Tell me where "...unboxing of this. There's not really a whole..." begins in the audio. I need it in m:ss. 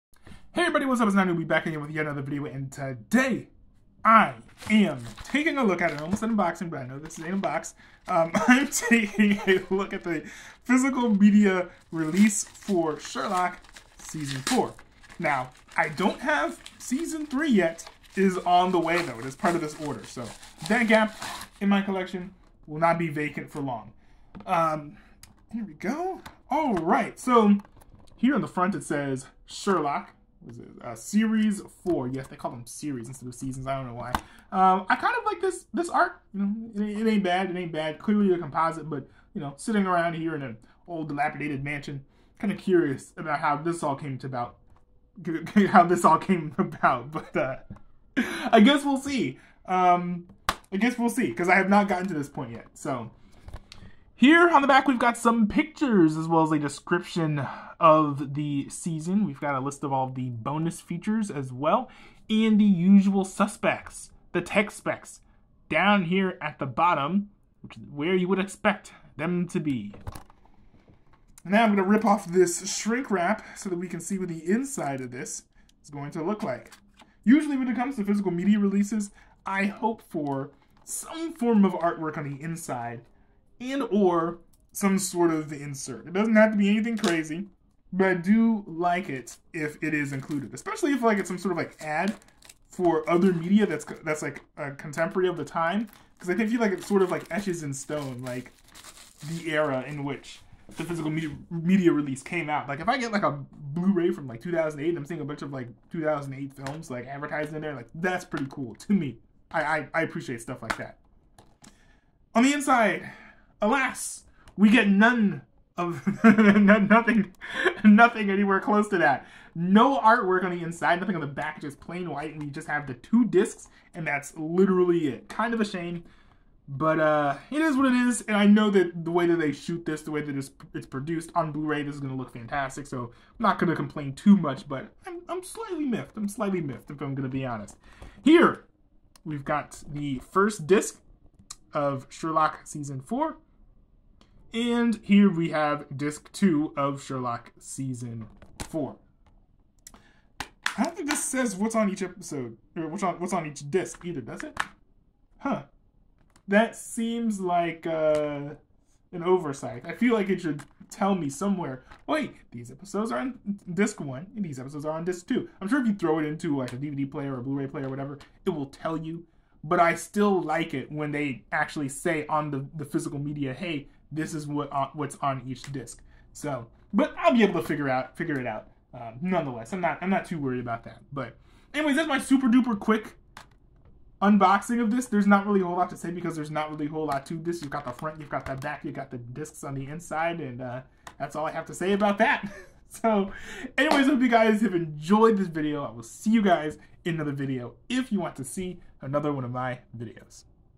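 3:04.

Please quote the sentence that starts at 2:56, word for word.
So, but I'll be able to figure out figure it out.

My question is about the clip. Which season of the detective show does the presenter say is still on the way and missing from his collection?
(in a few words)
Season 3.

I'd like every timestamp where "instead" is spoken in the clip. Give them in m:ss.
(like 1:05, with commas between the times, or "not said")
0:33.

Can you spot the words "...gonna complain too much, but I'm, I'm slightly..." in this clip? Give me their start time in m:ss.
2:13.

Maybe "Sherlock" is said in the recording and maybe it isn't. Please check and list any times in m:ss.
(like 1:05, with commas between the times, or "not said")
0:12, 0:29, 2:22, 2:27.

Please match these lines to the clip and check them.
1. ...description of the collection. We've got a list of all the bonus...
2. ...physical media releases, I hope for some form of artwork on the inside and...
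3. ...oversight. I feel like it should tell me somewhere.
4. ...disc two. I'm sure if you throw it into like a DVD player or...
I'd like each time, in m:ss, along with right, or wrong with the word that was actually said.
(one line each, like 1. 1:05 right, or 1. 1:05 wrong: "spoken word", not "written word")
1. 0:56 wrong: "season", not "collection"
2. 1:18 right
3. 2:39 right
4. 2:45 right.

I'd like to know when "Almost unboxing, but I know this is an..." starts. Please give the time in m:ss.
0:06.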